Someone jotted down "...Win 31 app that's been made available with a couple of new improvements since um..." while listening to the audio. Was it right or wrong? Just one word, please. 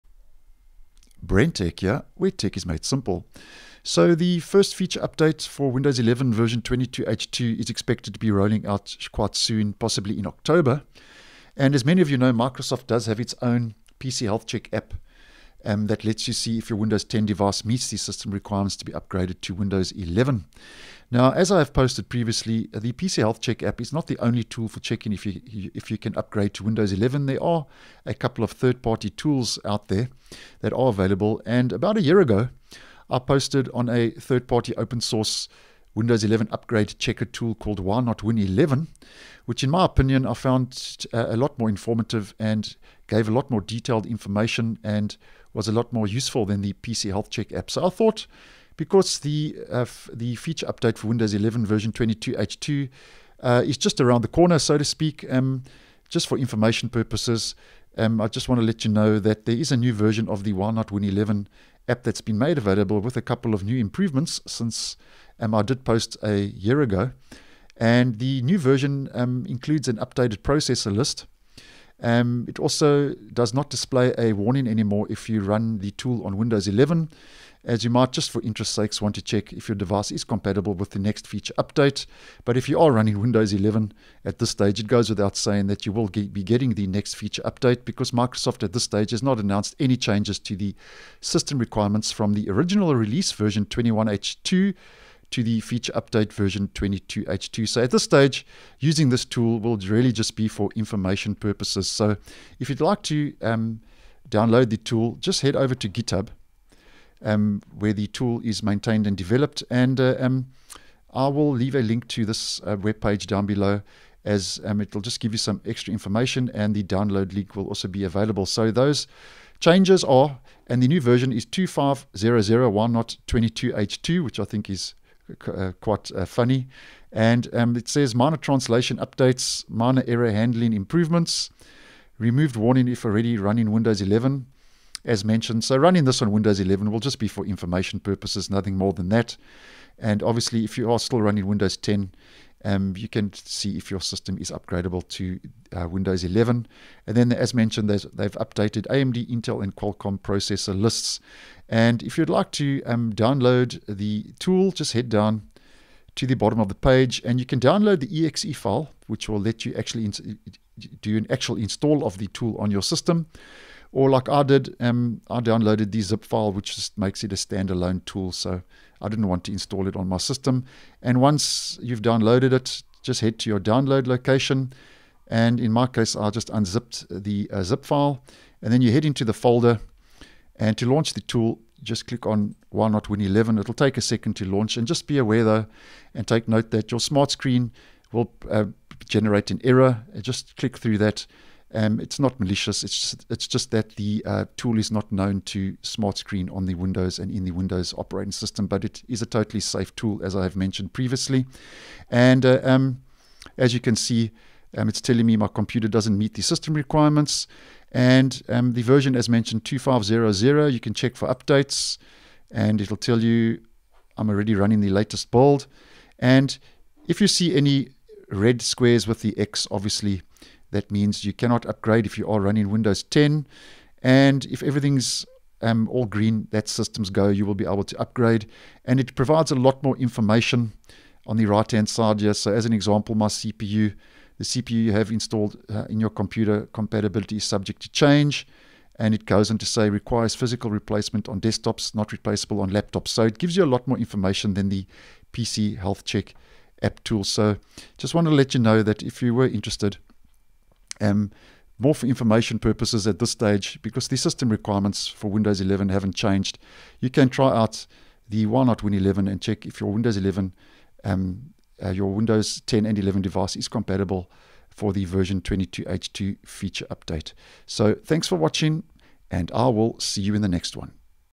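wrong.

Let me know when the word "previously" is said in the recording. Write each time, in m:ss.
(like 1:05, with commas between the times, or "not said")
0:22, 3:20.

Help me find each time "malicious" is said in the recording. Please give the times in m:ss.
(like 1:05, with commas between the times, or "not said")
3:12.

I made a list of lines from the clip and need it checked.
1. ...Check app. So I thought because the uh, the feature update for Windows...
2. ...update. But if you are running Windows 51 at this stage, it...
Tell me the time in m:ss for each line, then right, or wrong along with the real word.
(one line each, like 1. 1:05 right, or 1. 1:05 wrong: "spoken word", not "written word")
1. 0:47 right
2. 1:21 wrong: "11", not "51".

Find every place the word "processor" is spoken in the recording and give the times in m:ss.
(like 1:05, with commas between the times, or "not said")
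1:10, 2:30.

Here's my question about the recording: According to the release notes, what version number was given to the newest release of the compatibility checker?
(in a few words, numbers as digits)
25001.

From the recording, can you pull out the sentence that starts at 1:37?
So at this stage, using this tool will really just be for information purposes.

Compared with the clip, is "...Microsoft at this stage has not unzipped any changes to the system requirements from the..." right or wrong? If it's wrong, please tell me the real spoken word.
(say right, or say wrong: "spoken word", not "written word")
wrong: "announced", not "unzipped".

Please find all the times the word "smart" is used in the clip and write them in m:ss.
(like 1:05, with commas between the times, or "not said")
3:07, 3:15.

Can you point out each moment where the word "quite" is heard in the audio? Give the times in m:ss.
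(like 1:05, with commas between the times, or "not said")
0:09, 2:05.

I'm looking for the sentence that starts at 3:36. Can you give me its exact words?
And if you see any red squares with the X, obviously that means you cannot upgrade if you are running Windows 10.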